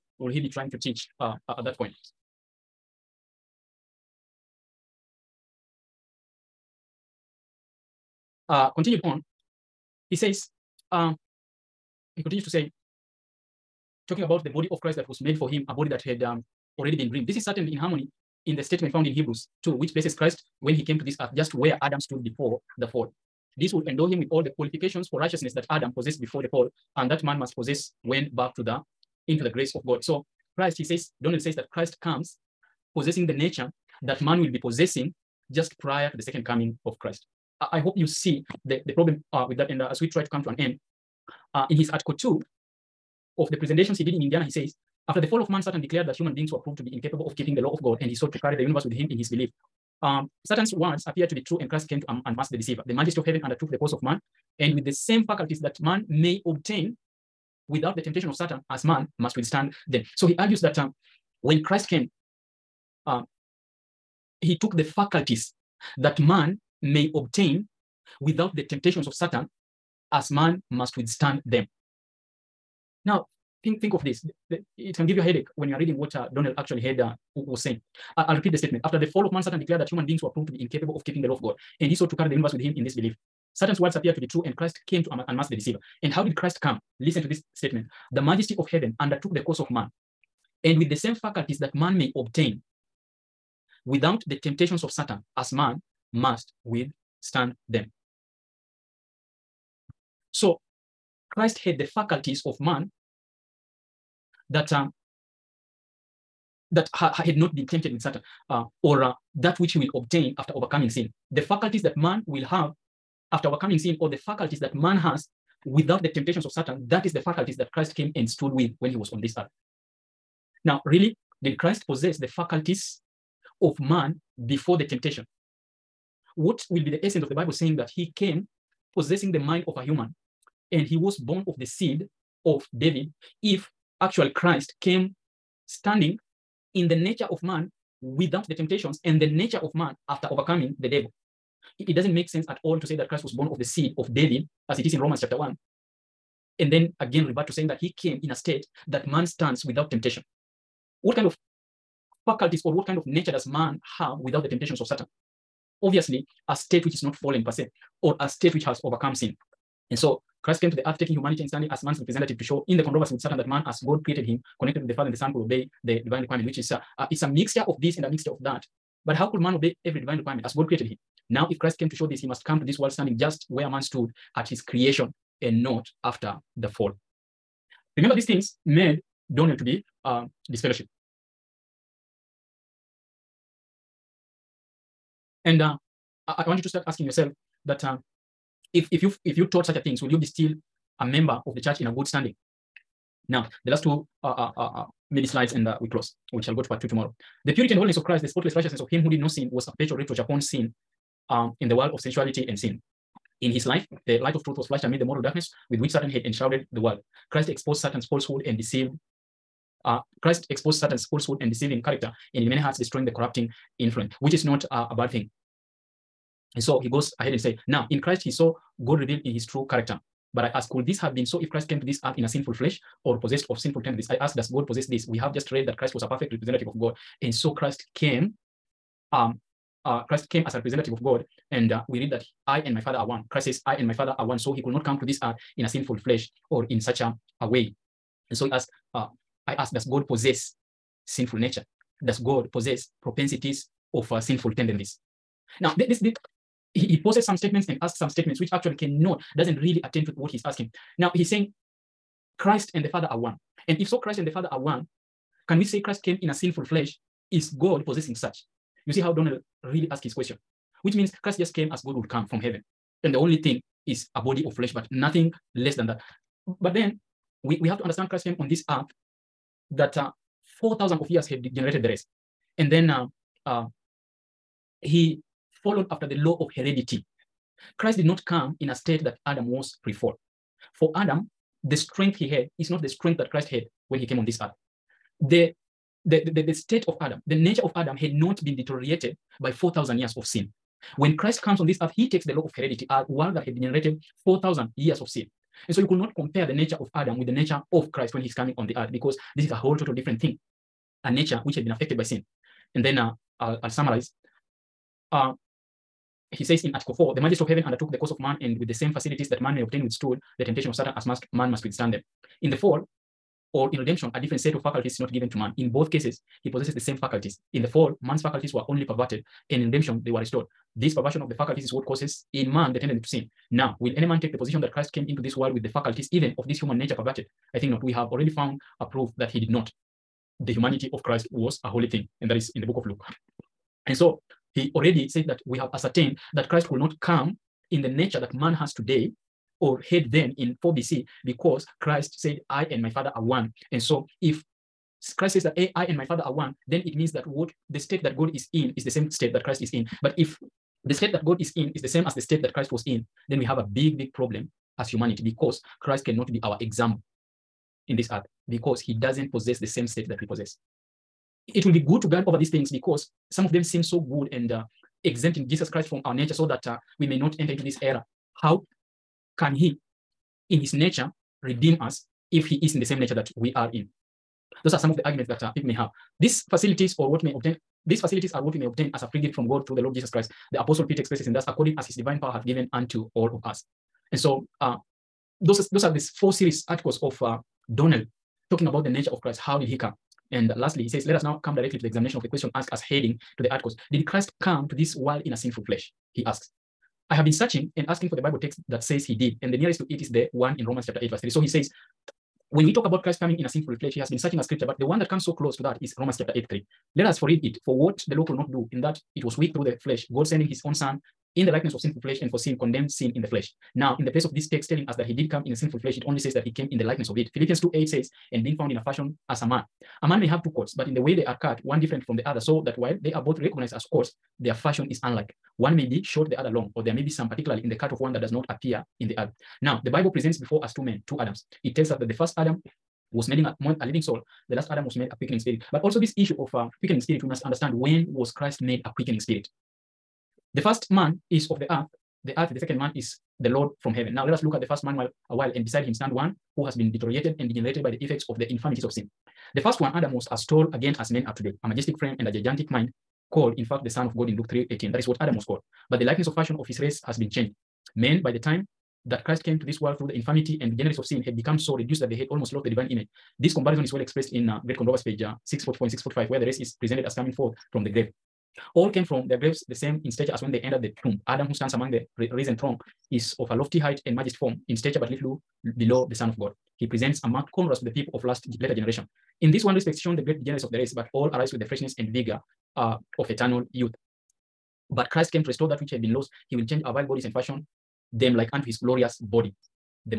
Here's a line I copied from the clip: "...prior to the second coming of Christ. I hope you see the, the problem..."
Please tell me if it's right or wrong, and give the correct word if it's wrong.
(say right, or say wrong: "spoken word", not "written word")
right.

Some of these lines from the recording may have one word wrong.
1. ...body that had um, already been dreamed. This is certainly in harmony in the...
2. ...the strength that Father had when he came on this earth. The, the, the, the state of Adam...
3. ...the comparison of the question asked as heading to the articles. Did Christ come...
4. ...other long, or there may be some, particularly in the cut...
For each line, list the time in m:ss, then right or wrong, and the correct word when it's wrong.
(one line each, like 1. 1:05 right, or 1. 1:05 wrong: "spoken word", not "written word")
1. 0:15 right
2. 4:42 wrong: "Christ", not "Father"
3. 6:31 wrong: "examination", not "comparison"
4. 7:06 right.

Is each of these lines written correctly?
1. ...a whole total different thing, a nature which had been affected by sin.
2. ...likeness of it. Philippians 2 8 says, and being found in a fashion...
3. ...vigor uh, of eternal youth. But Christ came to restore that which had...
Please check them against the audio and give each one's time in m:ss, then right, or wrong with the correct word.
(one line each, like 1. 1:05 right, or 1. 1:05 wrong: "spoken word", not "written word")
1. 4:59 right
2. 6:56 right
3. 8:02 right.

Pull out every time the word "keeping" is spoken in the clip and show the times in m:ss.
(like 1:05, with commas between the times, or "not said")
0:47, 1:21.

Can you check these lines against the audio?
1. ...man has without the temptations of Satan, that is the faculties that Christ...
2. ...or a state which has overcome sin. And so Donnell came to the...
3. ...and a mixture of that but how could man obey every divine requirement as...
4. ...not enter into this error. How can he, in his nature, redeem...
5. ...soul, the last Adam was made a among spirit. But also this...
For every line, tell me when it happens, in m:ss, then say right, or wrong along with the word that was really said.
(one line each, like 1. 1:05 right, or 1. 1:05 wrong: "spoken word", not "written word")
1. 1:54 right
2. 2:38 wrong: "Christ", not "Donnell"
3. 2:47 right
4. 6:07 right
5. 7:14 wrong: "quickening", not "among".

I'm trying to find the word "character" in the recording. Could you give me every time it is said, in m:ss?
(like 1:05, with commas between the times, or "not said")
3:31, 3:39.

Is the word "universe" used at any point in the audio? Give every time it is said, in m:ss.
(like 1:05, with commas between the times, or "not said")
0:48, 1:22.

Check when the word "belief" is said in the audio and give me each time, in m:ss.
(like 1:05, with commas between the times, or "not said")
0:49, 1:22.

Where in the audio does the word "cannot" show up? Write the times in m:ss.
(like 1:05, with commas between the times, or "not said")
4:08, 5:56.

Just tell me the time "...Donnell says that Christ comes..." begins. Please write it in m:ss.
0:31.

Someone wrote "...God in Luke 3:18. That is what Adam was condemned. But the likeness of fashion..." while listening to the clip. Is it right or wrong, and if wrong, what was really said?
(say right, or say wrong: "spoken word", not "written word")
wrong: "called", not "condemned".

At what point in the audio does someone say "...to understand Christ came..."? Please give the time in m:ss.
4:27.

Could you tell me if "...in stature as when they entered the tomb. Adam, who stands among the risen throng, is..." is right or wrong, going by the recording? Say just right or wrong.
right.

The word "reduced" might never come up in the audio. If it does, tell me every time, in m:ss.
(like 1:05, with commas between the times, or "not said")
7:41.